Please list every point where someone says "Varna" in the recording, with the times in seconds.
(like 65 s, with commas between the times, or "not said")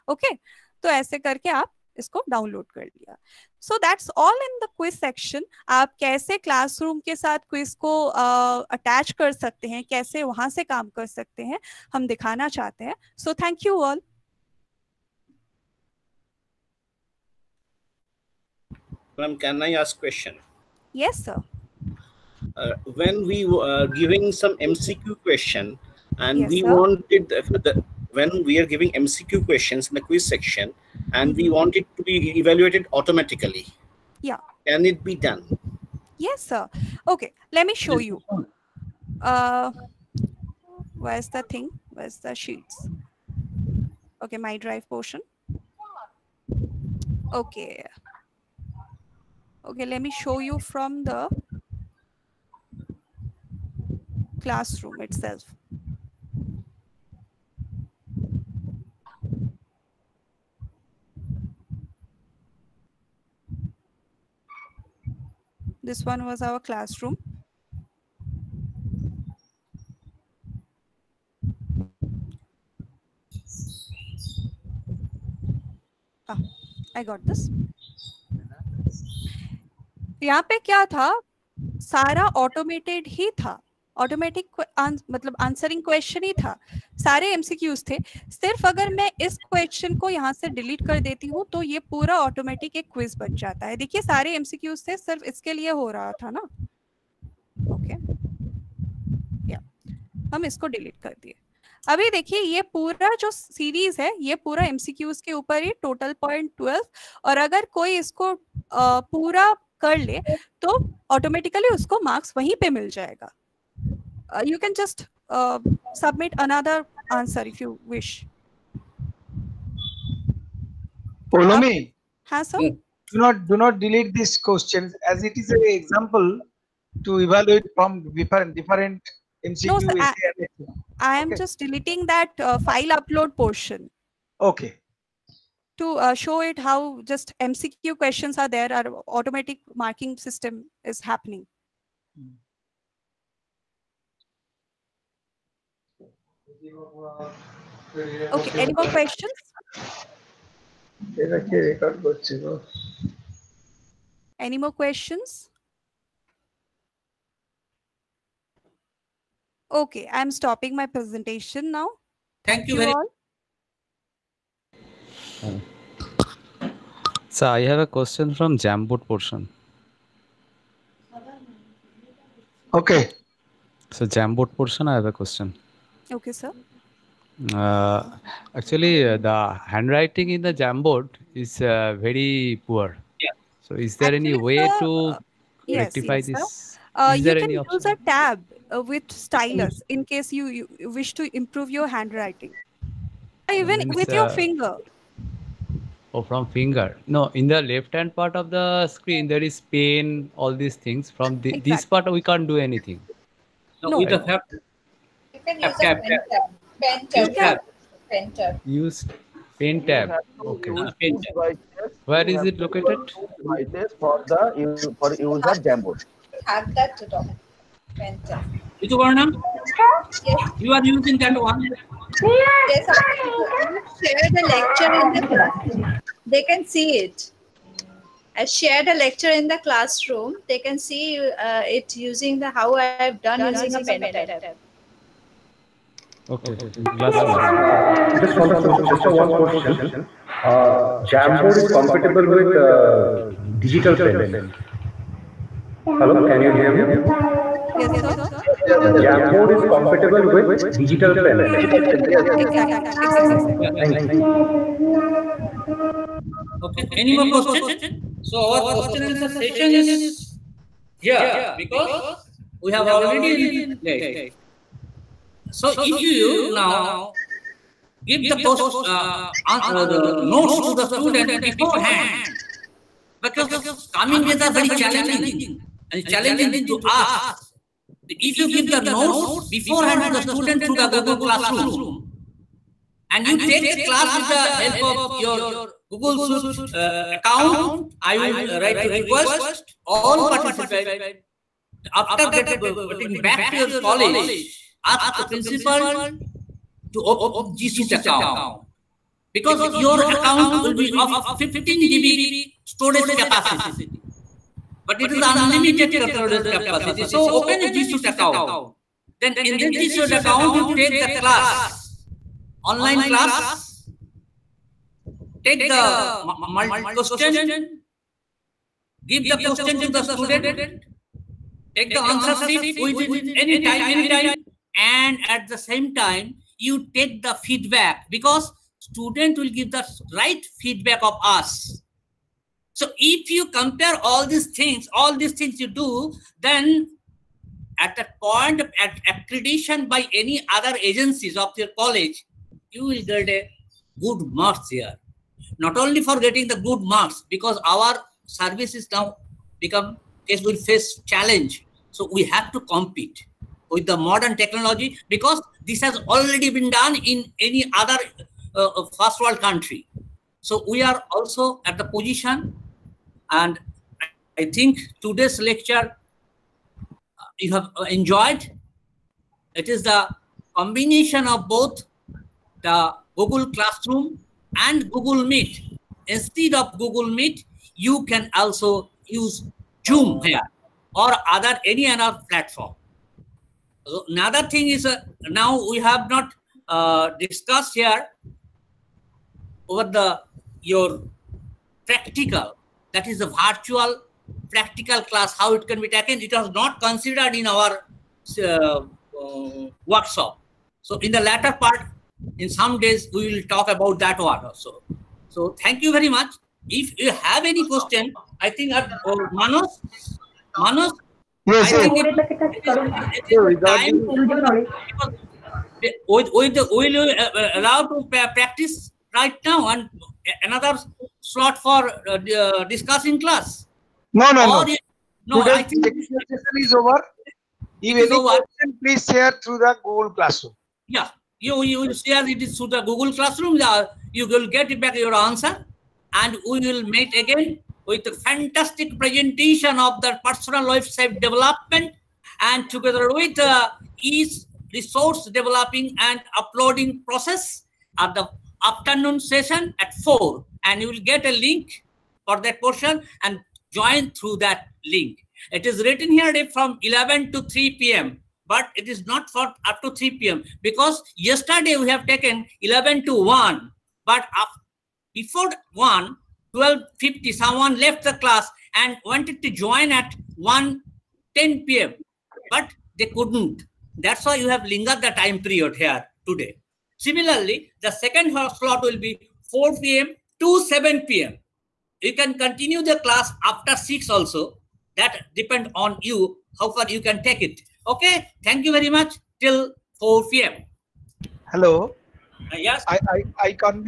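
218 s.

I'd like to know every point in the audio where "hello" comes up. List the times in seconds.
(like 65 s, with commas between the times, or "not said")
245 s, 491 s.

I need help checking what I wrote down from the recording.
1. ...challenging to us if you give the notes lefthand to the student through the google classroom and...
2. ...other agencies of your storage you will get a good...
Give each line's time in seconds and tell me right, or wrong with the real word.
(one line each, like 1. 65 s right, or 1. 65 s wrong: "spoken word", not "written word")
1. 276 s wrong: "beforehand", not "lefthand"
2. 340 s wrong: "college", not "storage".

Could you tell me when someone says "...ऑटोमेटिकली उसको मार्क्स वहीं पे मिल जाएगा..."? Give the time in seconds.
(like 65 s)
111 s.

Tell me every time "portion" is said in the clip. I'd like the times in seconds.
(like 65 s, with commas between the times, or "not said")
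44 s, 133 s, 169 s, 174 s, 452 s.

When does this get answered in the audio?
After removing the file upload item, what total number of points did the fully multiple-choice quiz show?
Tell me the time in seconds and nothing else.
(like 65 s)
105 s.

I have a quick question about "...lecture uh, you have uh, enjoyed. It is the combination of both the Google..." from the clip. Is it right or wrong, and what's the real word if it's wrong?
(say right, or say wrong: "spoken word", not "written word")
right.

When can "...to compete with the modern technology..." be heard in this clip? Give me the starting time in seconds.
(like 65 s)
352 s.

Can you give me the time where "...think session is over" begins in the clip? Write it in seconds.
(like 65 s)
425 s.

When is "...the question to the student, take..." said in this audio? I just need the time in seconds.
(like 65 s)
319 s.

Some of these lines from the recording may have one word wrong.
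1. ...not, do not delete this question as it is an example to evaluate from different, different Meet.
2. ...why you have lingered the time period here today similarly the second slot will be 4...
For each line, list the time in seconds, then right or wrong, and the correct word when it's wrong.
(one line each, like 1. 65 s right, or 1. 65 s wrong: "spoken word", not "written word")
1. 123 s wrong: "MCQ", not "Meet"
2. 474 s right.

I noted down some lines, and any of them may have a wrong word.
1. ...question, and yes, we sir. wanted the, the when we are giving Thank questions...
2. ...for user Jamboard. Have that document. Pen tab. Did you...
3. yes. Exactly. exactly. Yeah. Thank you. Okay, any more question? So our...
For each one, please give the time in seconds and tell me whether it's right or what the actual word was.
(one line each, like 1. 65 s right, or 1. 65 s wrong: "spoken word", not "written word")
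1. 25 s wrong: "MCQ", not "Thank"
2. 214 s right
3. 251 s right.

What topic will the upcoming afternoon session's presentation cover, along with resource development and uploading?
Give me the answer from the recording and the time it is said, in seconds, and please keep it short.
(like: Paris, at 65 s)
Personal website development, at 440 s.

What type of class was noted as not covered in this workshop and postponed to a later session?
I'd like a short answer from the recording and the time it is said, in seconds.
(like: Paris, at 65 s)
Virtual practical class, at 393 s.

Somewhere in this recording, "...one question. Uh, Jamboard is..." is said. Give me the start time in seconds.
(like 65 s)
239 s.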